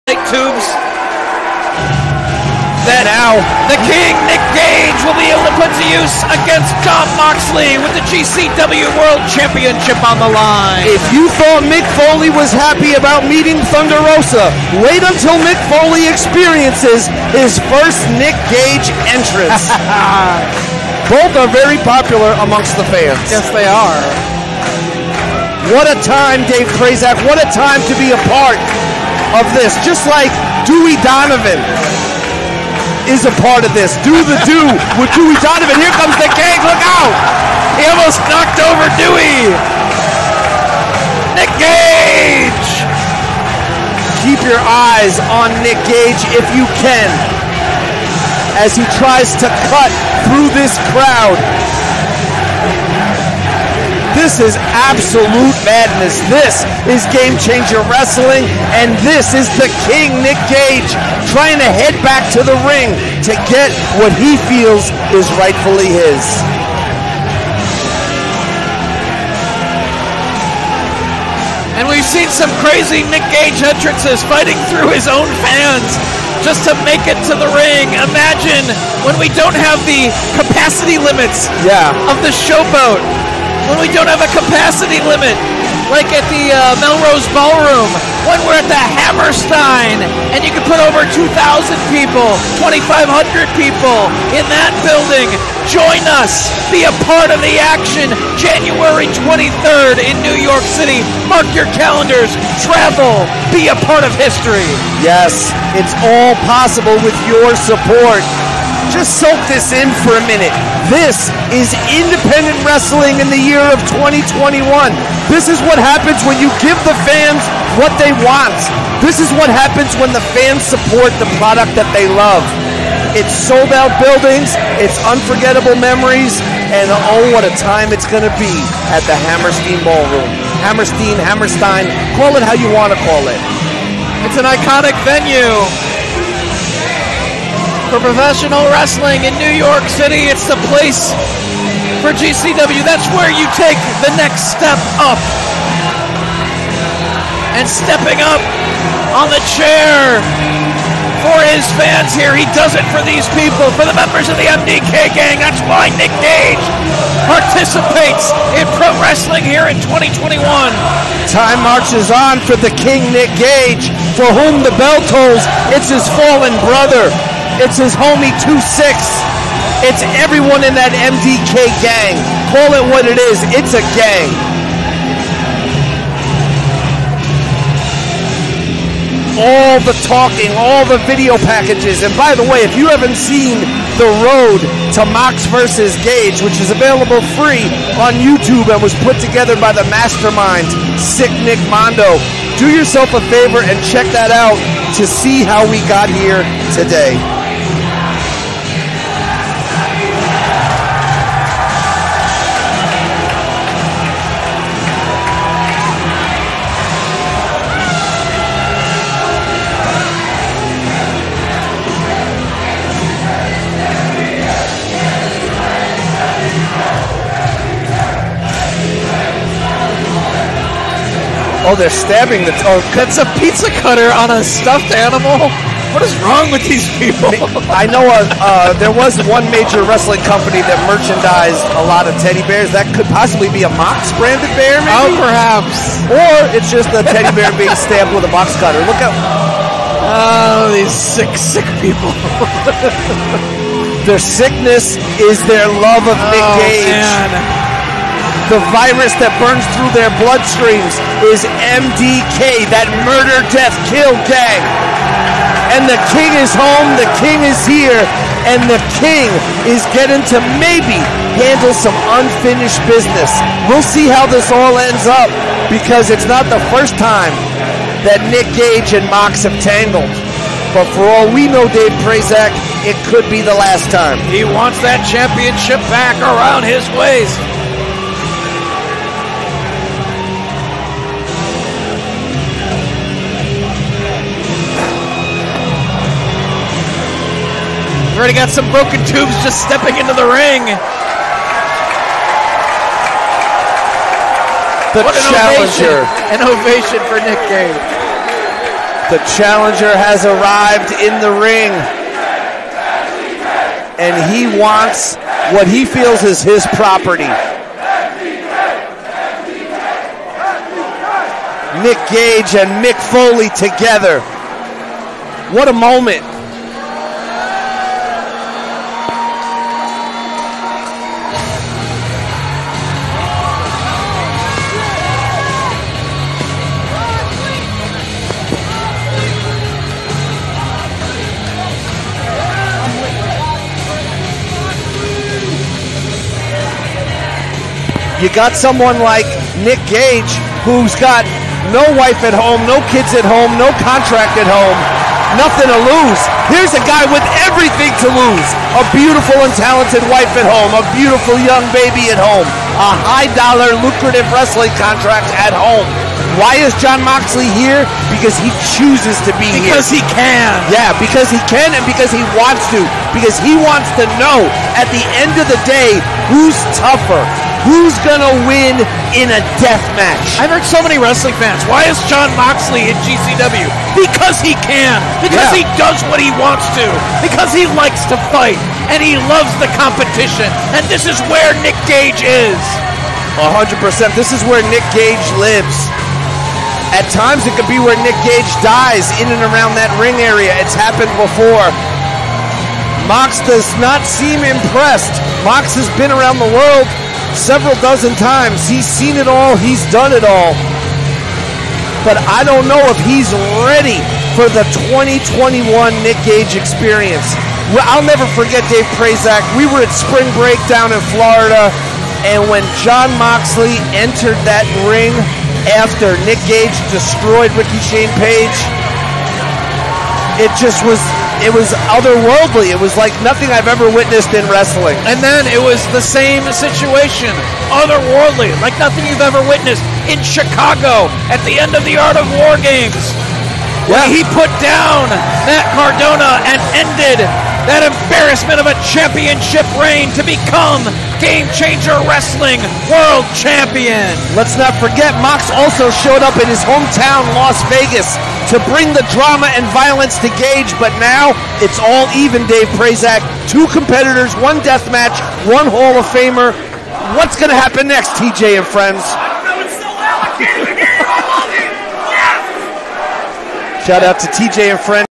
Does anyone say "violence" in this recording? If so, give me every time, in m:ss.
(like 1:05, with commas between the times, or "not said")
7:29.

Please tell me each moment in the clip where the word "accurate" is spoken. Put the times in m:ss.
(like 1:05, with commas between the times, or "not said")
not said.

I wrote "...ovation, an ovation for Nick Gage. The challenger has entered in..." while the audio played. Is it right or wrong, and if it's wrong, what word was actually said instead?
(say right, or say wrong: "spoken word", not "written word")
wrong: "arrived", not "entered".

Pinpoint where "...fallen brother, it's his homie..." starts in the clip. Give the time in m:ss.
2:46.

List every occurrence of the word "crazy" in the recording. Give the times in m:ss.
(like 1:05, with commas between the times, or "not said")
1:12.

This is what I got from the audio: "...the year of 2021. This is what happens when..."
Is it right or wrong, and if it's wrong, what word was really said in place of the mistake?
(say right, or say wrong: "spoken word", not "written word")
right.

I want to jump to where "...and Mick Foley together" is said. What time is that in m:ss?
5:12.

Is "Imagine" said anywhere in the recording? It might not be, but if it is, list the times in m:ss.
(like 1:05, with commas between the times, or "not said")
1:18.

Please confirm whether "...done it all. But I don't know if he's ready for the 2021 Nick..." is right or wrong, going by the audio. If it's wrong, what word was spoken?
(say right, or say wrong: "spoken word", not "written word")
right.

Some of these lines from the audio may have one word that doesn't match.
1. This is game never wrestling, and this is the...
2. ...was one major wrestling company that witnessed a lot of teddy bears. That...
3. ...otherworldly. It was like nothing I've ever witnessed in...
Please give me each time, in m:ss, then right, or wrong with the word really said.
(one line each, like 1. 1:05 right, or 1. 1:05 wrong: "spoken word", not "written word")
1. 0:56 wrong: "changer", not "never"
2. 3:48 wrong: "merchandised", not "witnessed"
3. 7:01 right.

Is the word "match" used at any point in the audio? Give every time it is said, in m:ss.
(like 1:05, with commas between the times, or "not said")
6:09, 7:34.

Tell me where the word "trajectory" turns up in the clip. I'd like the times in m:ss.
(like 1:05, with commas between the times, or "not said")
not said.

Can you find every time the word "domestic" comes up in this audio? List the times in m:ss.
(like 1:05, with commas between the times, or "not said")
not said.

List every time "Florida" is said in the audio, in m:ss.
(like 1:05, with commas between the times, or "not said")
6:51.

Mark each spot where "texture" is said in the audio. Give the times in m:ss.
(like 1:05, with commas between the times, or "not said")
not said.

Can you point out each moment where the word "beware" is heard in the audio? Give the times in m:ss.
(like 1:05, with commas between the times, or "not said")
not said.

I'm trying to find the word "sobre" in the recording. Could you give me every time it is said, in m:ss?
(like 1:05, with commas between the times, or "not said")
not said.